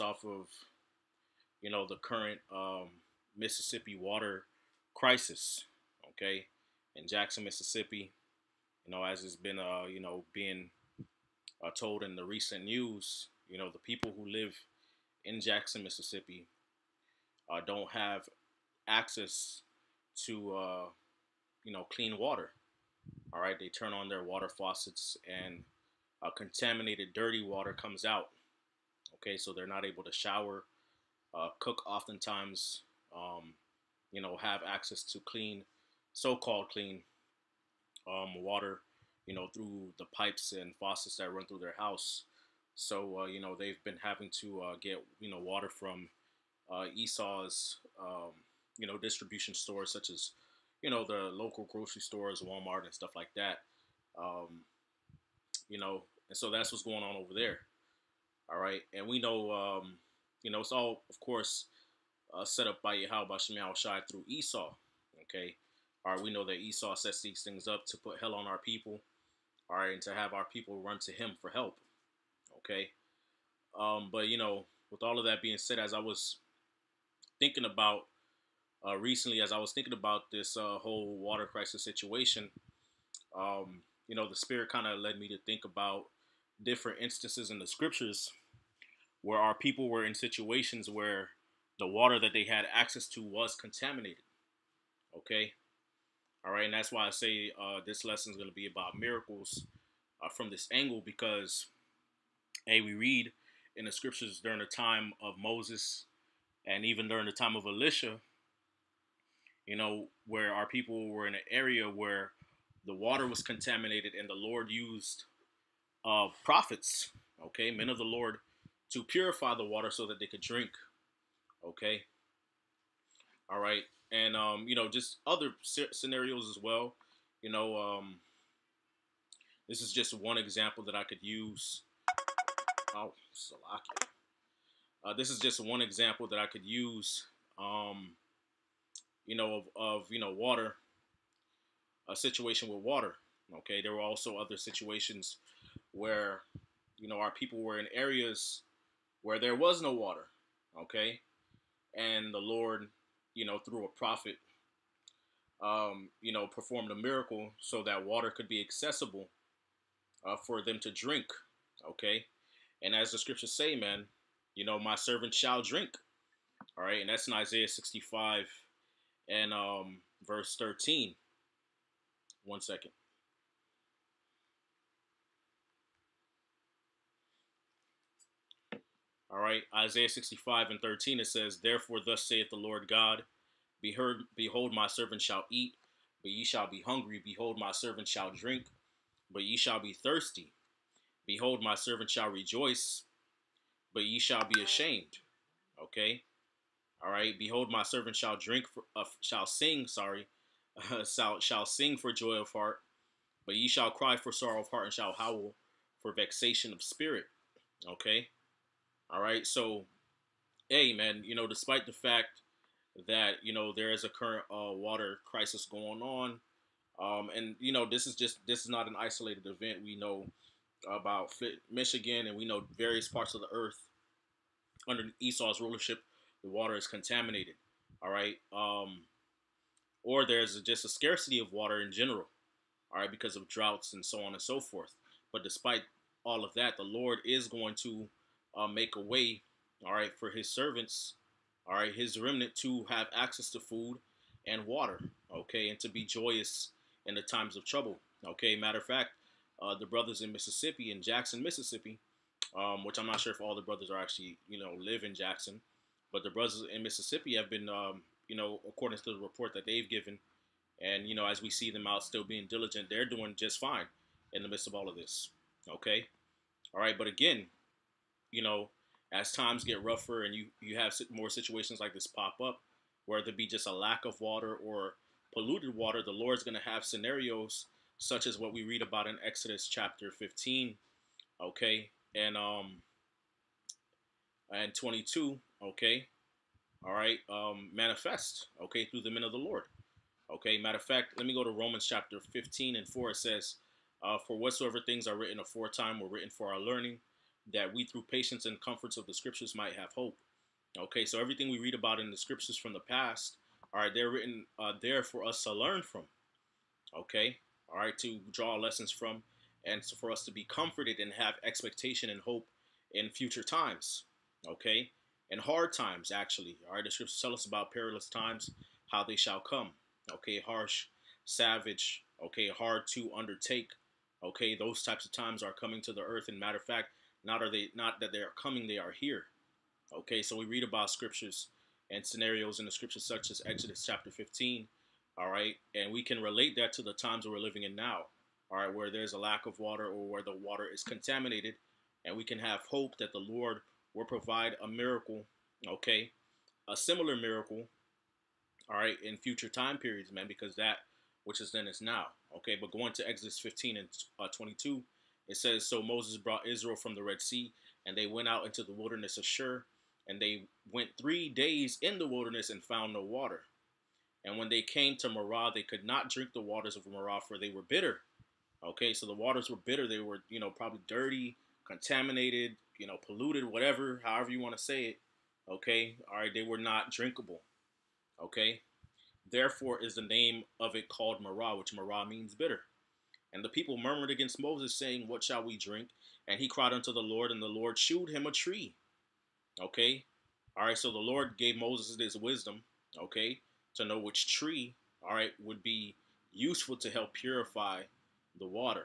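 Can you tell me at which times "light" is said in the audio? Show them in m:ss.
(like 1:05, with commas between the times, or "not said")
not said.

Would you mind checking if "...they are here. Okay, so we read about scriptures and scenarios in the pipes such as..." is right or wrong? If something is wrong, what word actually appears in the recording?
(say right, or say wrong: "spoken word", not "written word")
wrong: "scriptures", not "pipes".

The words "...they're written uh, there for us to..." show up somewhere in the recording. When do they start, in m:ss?
5:03.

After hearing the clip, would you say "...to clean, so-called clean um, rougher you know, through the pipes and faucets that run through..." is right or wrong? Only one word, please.
wrong.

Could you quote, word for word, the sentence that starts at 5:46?
A similar miracle, all right, in future time periods, man, because that which is then is now, okay?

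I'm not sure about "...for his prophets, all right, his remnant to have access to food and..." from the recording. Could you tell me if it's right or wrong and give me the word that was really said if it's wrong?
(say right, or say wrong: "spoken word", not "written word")
wrong: "servants", not "prophets".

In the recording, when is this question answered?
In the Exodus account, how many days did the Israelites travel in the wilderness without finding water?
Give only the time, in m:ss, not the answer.
6:00.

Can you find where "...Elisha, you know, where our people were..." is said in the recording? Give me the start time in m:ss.
1:47.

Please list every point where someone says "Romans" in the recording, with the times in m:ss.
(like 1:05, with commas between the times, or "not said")
4:51.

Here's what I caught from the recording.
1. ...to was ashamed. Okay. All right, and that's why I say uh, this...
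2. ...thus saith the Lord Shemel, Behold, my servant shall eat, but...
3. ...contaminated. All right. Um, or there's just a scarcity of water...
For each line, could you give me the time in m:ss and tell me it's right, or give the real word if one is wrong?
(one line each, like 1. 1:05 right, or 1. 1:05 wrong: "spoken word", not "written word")
1. 1:33 wrong: "contaminated", not "ashamed"
2. 3:02 wrong: "God", not "Shemel"
3. 3:46 right.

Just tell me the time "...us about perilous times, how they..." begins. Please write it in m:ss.
5:17.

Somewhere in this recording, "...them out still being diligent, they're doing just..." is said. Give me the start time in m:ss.
4:21.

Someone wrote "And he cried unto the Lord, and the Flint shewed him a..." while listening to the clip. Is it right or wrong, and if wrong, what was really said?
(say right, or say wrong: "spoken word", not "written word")
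wrong: "Lord", not "Flint".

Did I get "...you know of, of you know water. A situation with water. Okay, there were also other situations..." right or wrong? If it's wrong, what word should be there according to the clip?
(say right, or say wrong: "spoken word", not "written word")
right.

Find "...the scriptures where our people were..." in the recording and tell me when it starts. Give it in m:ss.
1:27.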